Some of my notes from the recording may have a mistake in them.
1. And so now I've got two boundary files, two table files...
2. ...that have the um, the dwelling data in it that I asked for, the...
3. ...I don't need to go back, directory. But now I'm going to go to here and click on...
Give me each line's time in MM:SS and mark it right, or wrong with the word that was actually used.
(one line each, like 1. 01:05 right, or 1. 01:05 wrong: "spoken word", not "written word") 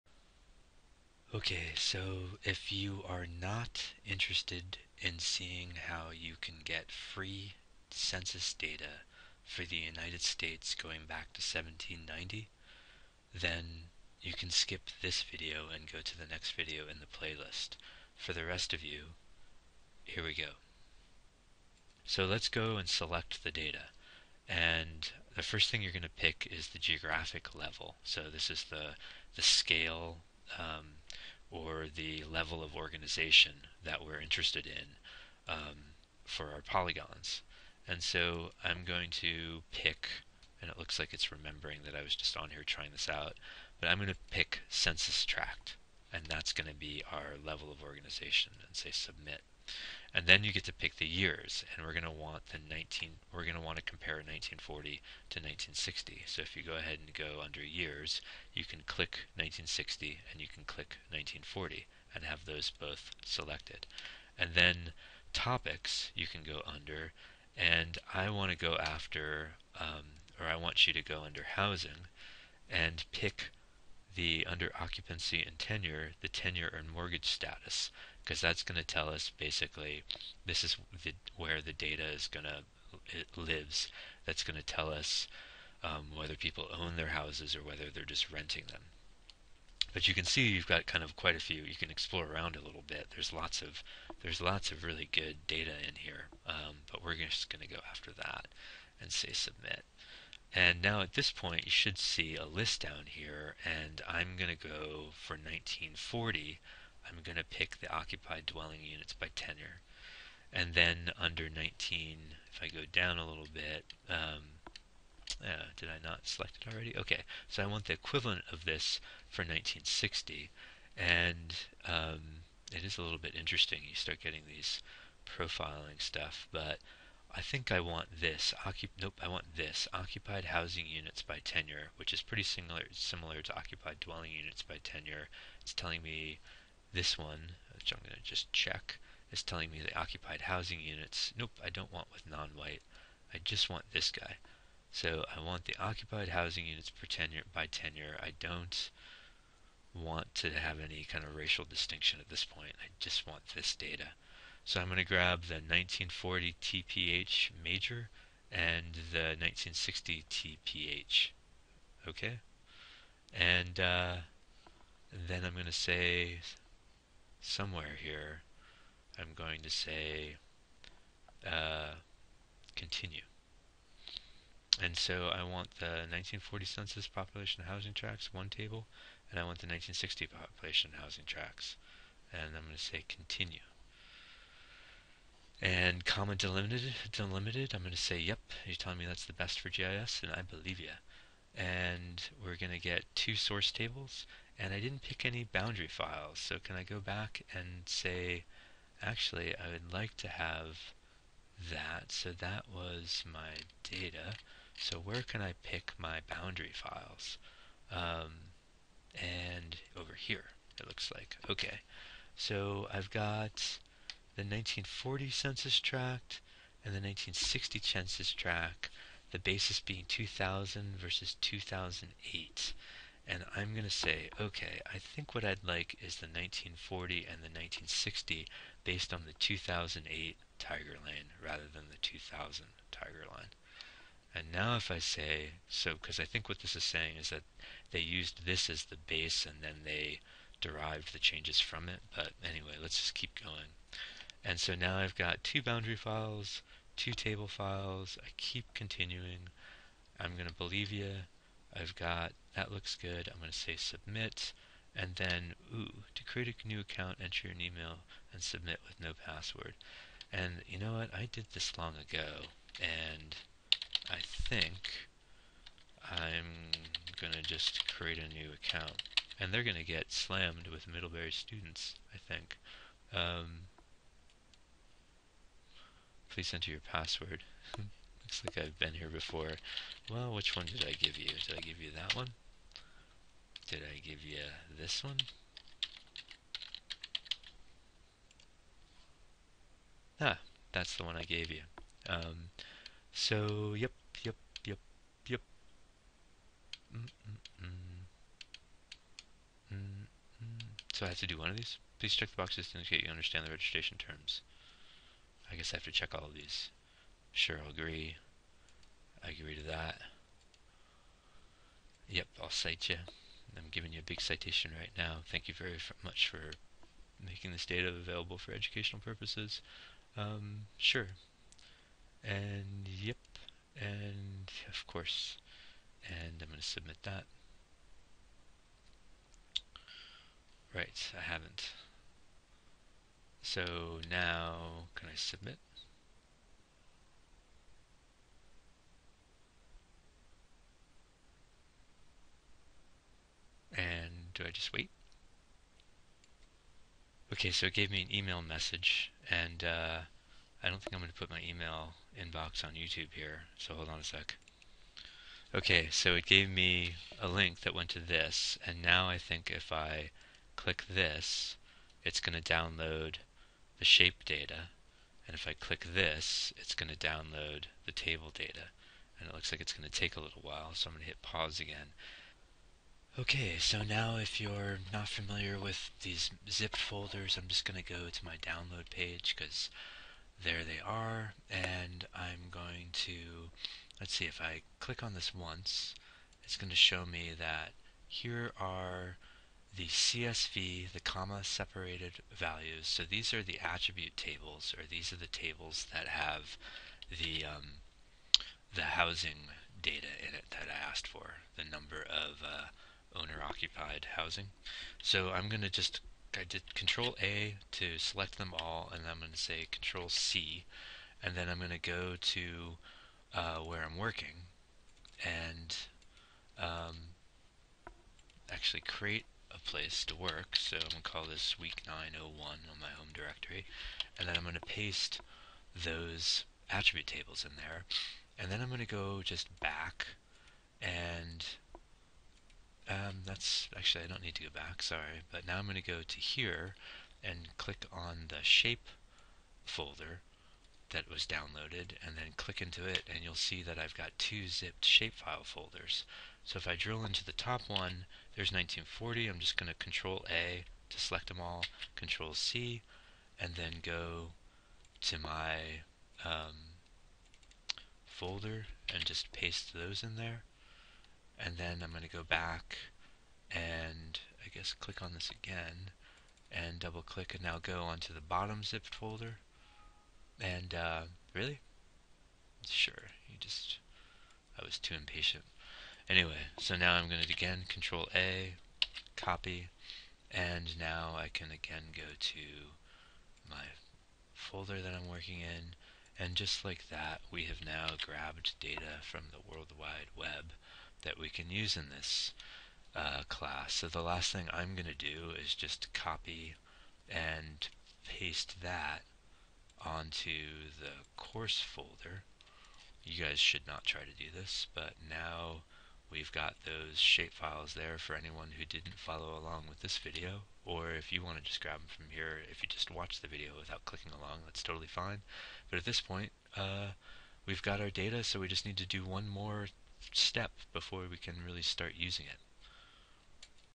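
1. 04:04 right
2. 06:35 wrong: "housing", not "dwelling"
3. 07:14 wrong: "sorry", not "directory".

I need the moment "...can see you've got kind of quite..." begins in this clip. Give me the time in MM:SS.
01:30.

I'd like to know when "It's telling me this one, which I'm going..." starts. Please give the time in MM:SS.
02:15.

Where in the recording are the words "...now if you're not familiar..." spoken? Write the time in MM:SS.
06:13.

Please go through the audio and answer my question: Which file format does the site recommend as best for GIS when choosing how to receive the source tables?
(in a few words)
comma delimited.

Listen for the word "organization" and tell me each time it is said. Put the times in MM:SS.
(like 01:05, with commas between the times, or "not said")
00:32, 00:47.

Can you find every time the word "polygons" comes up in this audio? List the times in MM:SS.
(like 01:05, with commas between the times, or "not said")
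00:36.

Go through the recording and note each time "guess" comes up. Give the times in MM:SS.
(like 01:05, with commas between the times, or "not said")
05:05, 07:44.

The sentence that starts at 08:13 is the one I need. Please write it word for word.
So the last thing I'm going to do is just copy and paste that onto the course folder.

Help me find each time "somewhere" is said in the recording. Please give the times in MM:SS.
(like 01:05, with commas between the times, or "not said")
02:47.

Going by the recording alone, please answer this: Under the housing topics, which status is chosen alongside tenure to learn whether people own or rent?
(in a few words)
mortgage status.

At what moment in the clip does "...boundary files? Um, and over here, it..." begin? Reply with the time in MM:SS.
03:26.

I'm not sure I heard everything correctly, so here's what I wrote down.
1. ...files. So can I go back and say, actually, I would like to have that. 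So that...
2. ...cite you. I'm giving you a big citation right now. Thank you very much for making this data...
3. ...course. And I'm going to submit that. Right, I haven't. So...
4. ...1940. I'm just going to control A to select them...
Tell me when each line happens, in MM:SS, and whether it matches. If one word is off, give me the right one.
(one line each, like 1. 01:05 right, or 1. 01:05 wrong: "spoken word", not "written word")
1. 03:15 right
2. 05:12 right
3. 05:24 right
4. 07:28 right.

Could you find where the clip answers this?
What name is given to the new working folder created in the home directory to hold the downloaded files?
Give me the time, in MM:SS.
07:01.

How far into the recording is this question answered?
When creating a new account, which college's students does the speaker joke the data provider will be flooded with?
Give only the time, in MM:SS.
04:30.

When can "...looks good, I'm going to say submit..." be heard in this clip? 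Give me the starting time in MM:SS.
04:12.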